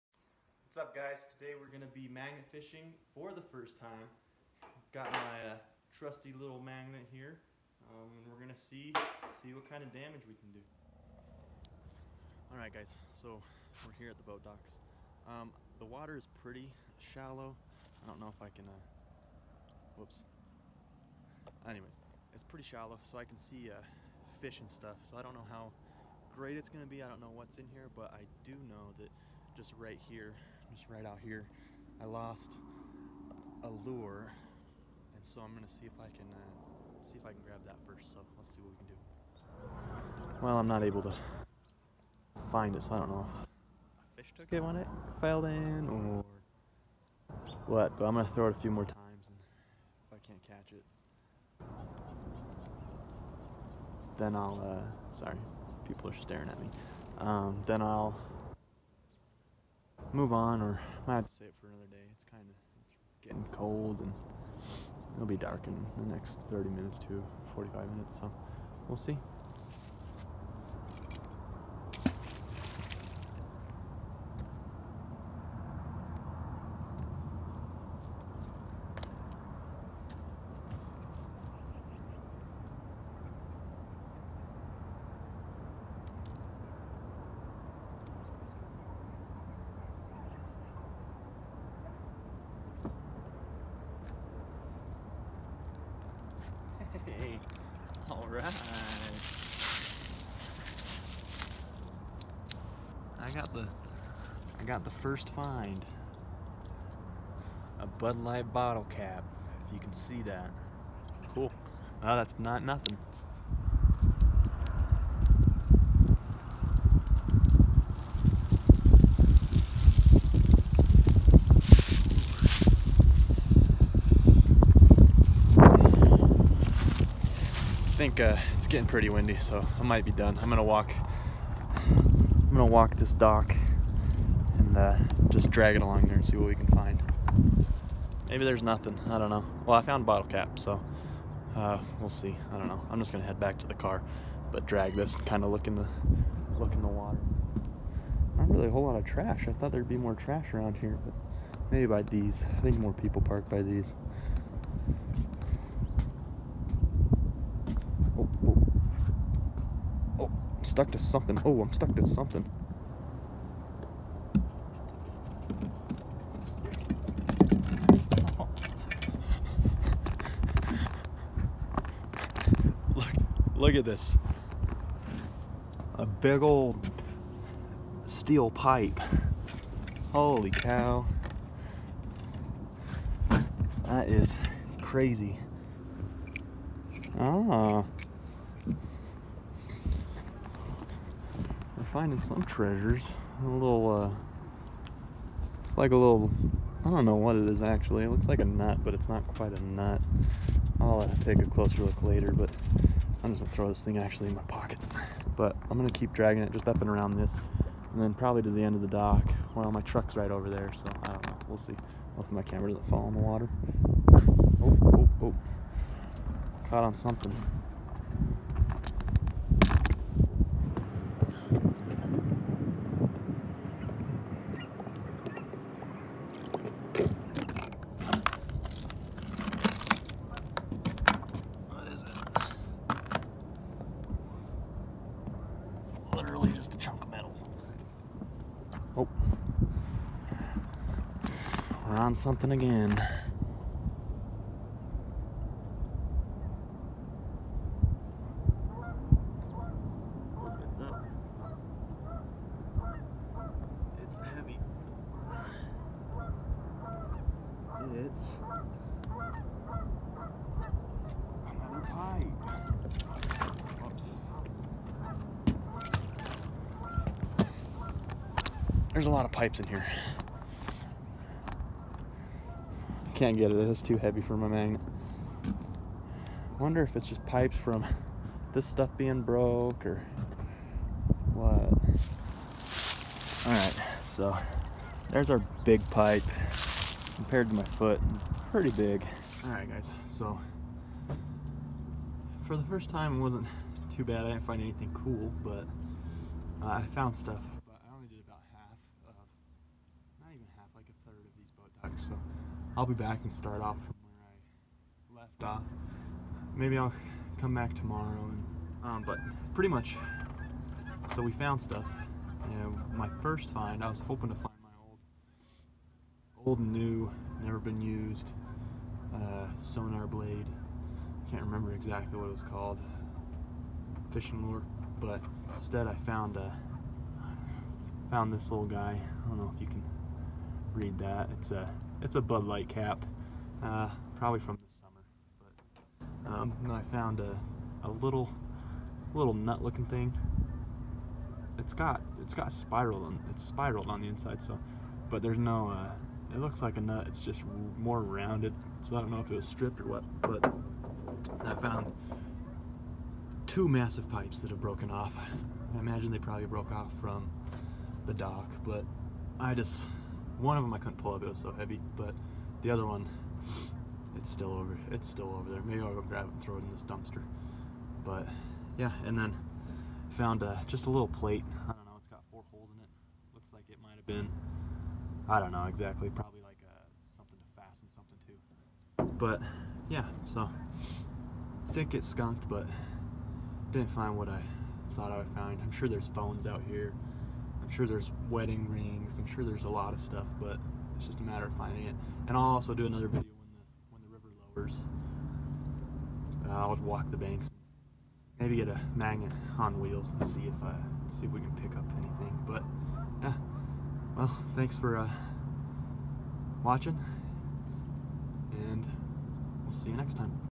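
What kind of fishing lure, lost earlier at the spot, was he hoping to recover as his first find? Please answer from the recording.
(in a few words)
sonar blade.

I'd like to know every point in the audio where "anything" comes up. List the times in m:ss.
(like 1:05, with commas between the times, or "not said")
4:54, 6:41.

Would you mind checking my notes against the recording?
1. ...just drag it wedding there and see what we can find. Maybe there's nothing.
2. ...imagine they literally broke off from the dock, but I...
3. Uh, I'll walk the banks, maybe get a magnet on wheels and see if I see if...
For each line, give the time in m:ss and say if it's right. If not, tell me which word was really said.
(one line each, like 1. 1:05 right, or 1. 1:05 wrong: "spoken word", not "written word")
1. 2:15 wrong: "along", not "wedding"
2. 5:55 wrong: "probably", not "literally"
3. 6:36 right.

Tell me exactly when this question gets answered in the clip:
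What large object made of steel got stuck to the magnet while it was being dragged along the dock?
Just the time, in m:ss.
2:55.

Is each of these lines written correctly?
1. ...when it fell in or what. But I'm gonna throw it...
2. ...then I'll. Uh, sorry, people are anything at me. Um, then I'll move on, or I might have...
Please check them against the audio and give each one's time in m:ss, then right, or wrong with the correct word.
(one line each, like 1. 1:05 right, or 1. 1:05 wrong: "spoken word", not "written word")
1. 0:44 right
2. 0:54 wrong: "staring", not "anything".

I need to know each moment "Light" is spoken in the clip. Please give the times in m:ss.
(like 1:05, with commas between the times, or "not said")
1:48, 5:32.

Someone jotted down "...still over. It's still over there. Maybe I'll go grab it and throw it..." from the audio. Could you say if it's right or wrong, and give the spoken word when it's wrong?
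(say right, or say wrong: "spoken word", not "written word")
right.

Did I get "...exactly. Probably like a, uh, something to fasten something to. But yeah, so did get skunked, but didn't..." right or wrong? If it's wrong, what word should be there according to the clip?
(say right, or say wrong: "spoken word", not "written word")
right.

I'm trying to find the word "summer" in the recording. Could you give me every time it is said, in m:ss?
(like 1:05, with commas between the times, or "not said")
5:34.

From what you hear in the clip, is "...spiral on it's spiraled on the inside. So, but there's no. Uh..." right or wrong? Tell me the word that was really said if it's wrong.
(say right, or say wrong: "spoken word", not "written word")
right.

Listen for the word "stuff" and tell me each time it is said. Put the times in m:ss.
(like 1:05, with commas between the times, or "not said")
0:24, 4:38, 4:57, 5:11, 6:30.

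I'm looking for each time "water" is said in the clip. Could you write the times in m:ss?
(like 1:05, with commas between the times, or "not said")
0:15, 2:26, 3:33.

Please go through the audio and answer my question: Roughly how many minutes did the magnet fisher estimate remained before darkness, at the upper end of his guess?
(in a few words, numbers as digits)
45.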